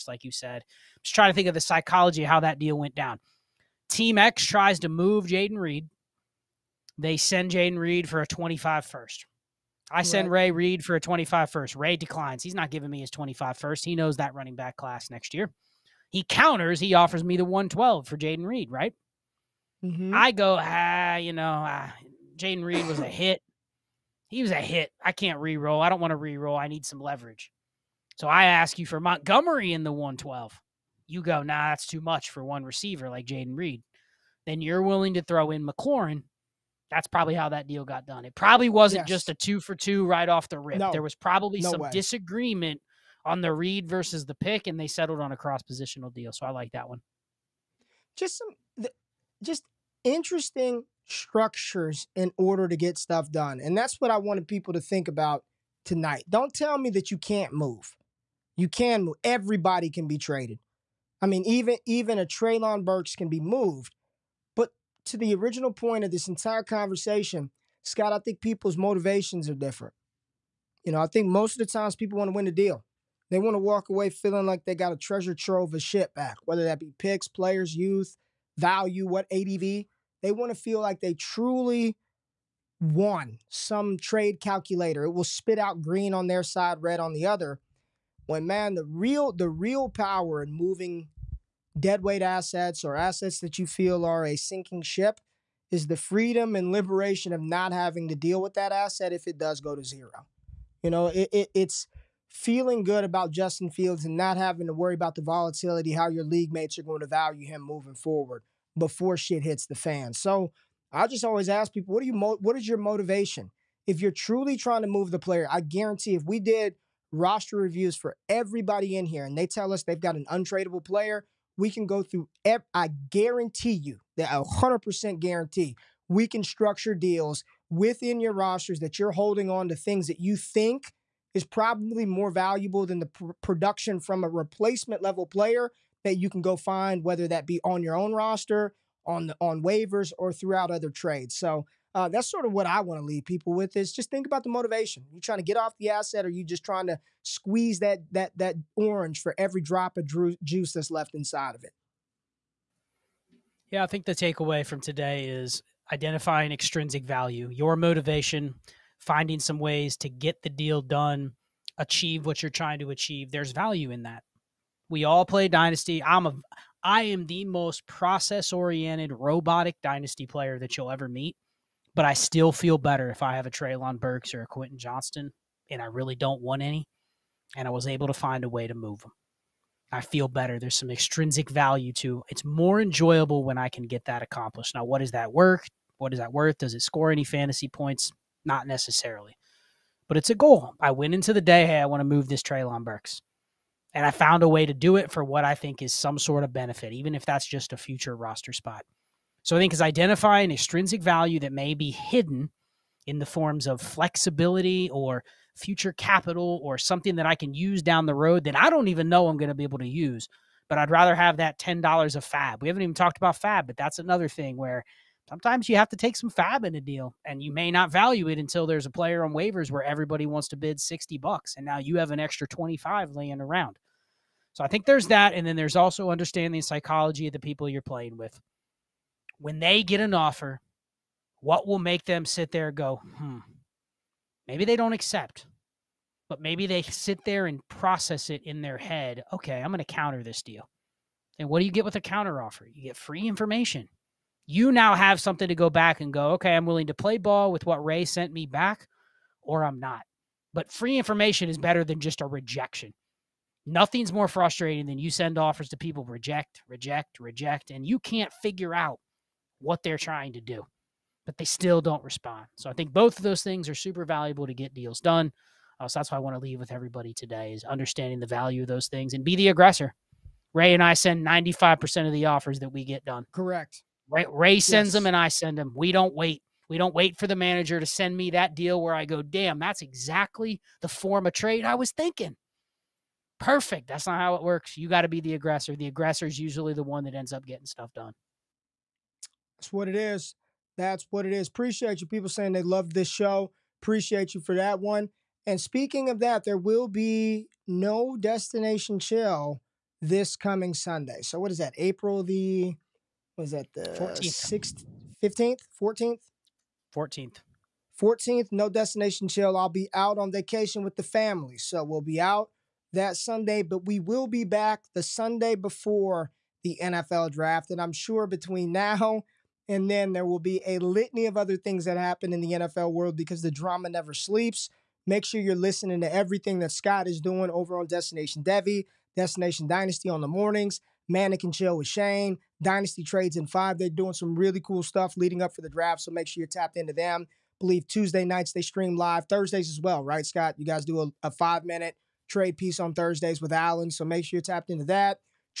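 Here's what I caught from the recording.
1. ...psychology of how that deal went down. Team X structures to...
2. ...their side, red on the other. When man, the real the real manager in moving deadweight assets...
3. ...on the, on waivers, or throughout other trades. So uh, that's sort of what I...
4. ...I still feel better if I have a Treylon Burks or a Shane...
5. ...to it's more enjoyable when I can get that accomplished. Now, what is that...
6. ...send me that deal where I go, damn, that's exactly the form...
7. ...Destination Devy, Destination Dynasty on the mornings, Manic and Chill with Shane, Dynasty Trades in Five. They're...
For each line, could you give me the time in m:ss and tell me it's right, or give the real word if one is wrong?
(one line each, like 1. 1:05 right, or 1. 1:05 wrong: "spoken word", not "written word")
1. 0:01 wrong: "tries", not "structures"
2. 1:26 wrong: "power", not "manager"
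3. 2:19 right
4. 2:52 wrong: "Quentin", not "Shane"
5. 3:01 right
6. 4:37 right
7. 5:27 right.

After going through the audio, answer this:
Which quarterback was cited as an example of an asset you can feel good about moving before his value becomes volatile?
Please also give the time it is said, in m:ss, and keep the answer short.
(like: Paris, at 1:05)
Justin Fields, at 1:43.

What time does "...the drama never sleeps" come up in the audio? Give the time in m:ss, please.
5:23.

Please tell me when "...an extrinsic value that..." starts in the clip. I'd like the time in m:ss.
3:20.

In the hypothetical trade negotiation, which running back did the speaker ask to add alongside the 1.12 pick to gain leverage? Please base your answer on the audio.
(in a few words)
Montgomery.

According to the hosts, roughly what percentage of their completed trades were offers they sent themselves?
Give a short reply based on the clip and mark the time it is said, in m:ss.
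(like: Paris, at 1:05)
95%, at 4:31.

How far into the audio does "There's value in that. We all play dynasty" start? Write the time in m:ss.
2:43.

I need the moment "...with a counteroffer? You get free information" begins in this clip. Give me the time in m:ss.
4:01.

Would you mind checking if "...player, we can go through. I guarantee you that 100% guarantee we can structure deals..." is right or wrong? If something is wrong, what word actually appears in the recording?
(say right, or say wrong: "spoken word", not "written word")
right.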